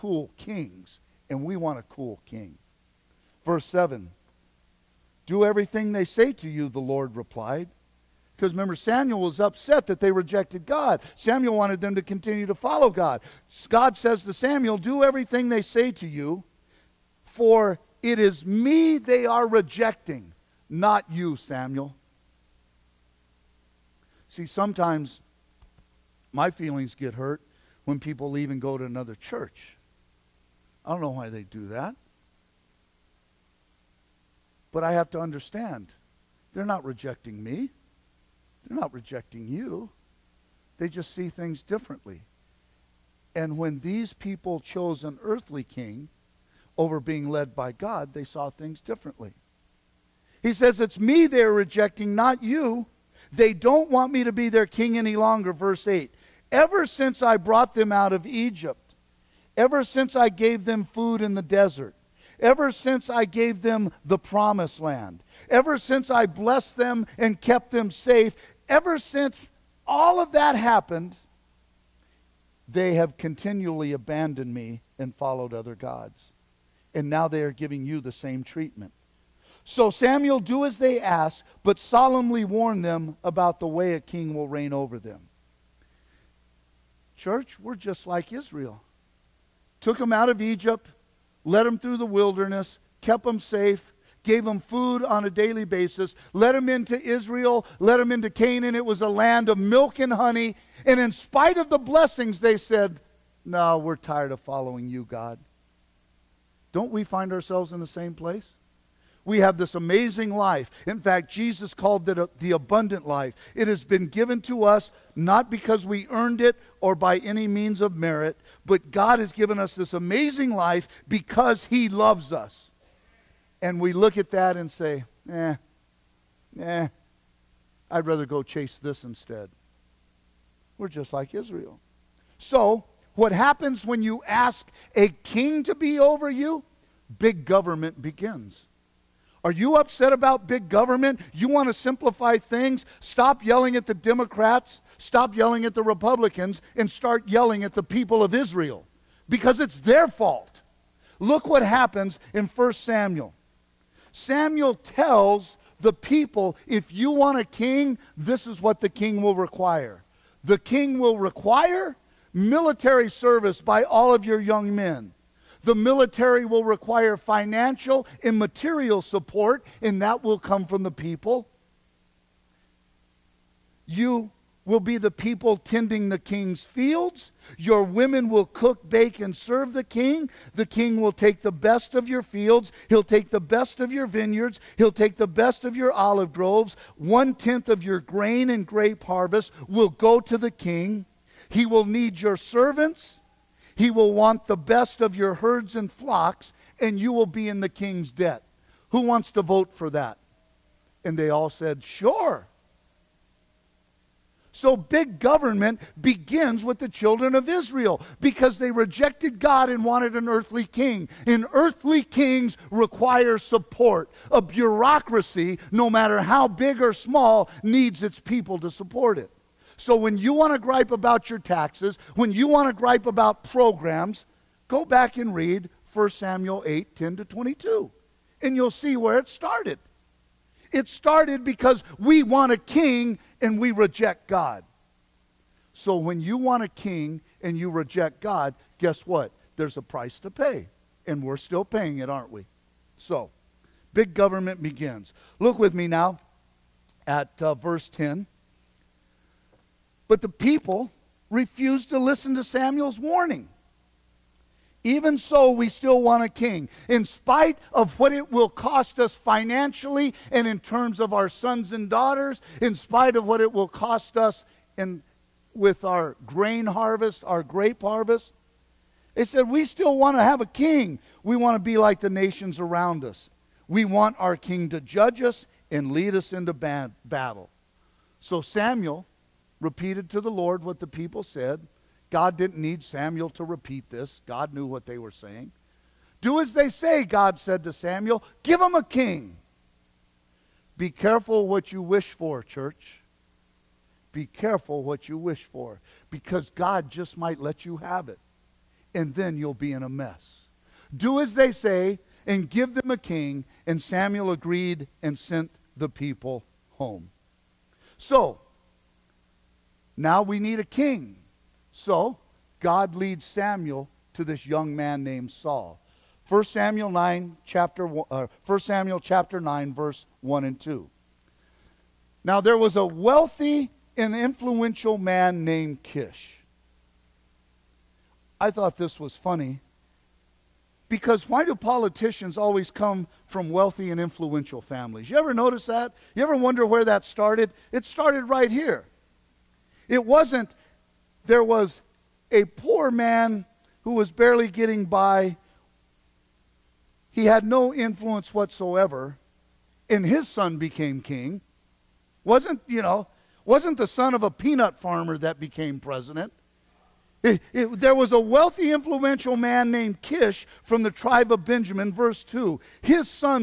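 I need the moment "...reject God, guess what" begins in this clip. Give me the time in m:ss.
3:57.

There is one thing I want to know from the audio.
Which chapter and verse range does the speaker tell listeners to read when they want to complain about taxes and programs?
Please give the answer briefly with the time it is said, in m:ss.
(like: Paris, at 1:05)
1 Samuel 8:10-22, at 3:45.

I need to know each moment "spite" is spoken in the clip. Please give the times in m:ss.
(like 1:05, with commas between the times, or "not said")
1:41, 4:17, 4:22.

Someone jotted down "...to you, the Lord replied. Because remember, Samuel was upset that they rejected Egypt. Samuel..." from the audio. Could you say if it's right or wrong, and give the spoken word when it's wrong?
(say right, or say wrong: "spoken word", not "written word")
wrong: "God", not "Egypt".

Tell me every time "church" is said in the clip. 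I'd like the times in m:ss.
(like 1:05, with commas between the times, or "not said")
0:29, 1:27, 4:52.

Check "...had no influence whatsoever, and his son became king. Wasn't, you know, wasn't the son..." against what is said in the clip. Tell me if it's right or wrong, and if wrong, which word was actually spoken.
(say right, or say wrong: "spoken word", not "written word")
right.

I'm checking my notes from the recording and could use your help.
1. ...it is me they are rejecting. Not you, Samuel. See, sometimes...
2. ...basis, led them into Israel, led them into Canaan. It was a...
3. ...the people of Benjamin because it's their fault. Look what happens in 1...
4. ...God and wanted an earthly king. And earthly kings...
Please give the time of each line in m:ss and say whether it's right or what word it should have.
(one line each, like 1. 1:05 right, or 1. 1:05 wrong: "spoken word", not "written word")
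1. 0:18 right
2. 1:35 right
3. 2:27 wrong: "Israel", not "Benjamin"
4. 3:29 right.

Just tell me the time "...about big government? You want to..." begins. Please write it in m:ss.
2:20.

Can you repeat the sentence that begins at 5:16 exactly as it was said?
1 Samuel 9 chapter 1, uh, 1 Samuel chapter 9 verse 1 and 2.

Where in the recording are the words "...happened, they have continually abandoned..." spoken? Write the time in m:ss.
1:10.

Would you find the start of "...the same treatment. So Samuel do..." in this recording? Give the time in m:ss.
1:18.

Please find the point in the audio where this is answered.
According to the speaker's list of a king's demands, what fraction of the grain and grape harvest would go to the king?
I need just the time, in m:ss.
3:06.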